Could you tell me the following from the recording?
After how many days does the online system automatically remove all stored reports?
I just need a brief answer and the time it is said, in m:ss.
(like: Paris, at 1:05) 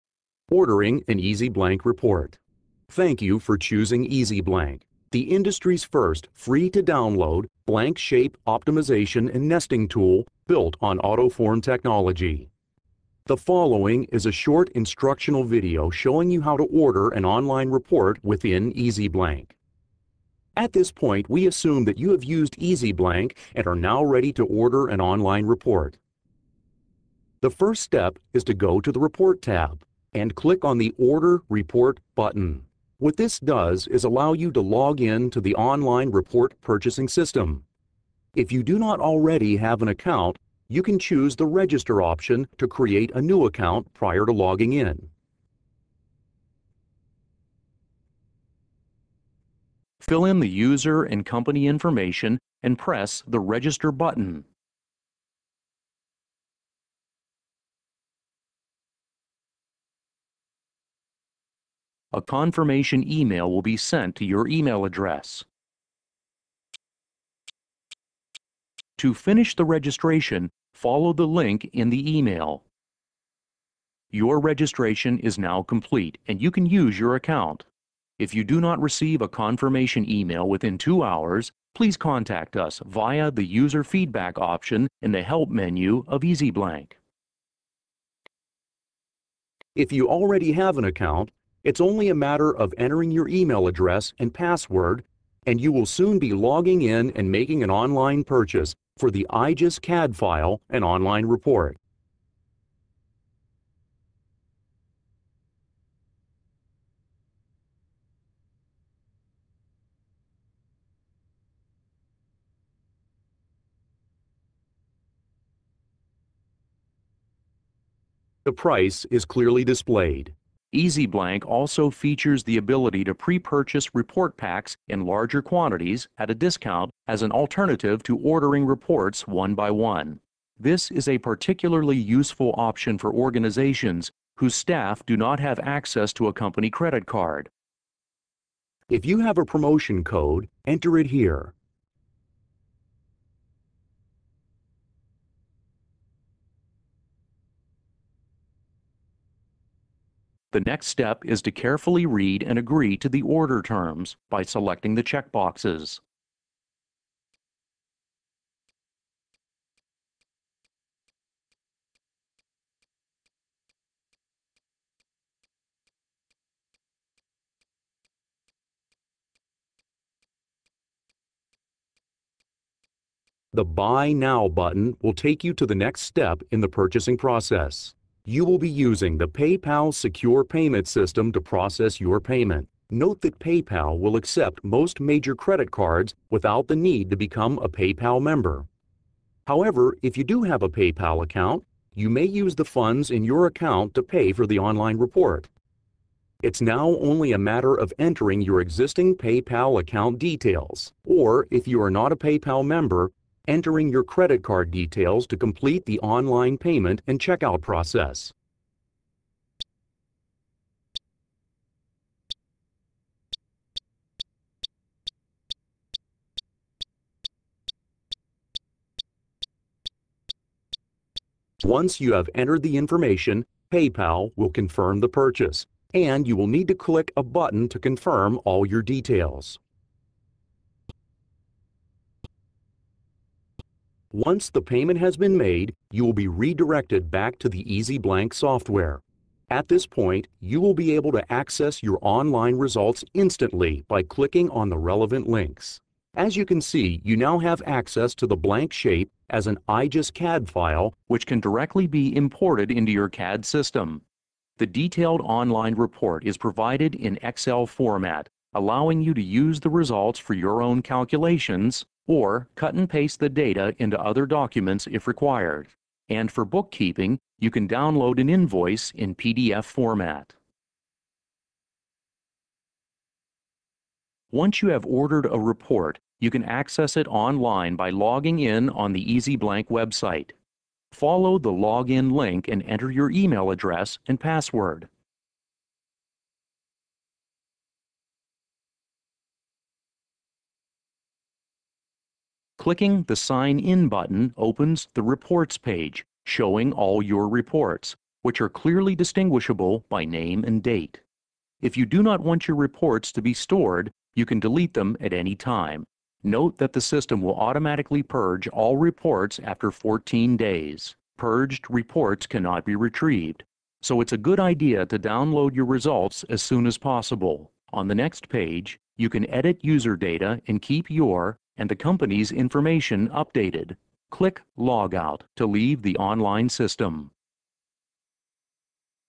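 14, at 5:09.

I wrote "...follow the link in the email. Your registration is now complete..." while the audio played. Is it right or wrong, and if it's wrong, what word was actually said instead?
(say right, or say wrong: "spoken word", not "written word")
right.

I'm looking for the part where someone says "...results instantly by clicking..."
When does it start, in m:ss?
4:02.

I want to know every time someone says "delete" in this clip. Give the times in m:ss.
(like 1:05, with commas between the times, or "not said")
5:04.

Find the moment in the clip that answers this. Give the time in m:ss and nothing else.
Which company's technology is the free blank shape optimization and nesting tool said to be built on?
0:10.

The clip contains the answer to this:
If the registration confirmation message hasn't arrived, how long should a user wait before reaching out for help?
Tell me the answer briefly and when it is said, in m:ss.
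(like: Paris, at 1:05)
2 hours, at 1:20.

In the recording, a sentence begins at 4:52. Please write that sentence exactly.
Clicking the Sign In button opens the Reports page, showing all your reports, which are clearly distinguishable by name and date.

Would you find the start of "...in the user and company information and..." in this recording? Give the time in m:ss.
0:50.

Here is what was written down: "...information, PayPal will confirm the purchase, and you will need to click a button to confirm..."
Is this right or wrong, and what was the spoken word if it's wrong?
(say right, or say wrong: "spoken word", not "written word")
right.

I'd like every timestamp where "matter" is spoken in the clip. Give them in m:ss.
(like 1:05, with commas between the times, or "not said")
1:32, 3:17.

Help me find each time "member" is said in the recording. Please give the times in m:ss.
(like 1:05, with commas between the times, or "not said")
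3:08, 3:22.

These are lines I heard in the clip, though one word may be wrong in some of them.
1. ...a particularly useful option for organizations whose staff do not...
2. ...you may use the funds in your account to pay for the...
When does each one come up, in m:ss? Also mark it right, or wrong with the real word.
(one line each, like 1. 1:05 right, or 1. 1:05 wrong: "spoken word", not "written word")
1. 2:11 right
2. 3:11 right.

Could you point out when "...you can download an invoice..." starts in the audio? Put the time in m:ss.
4:27.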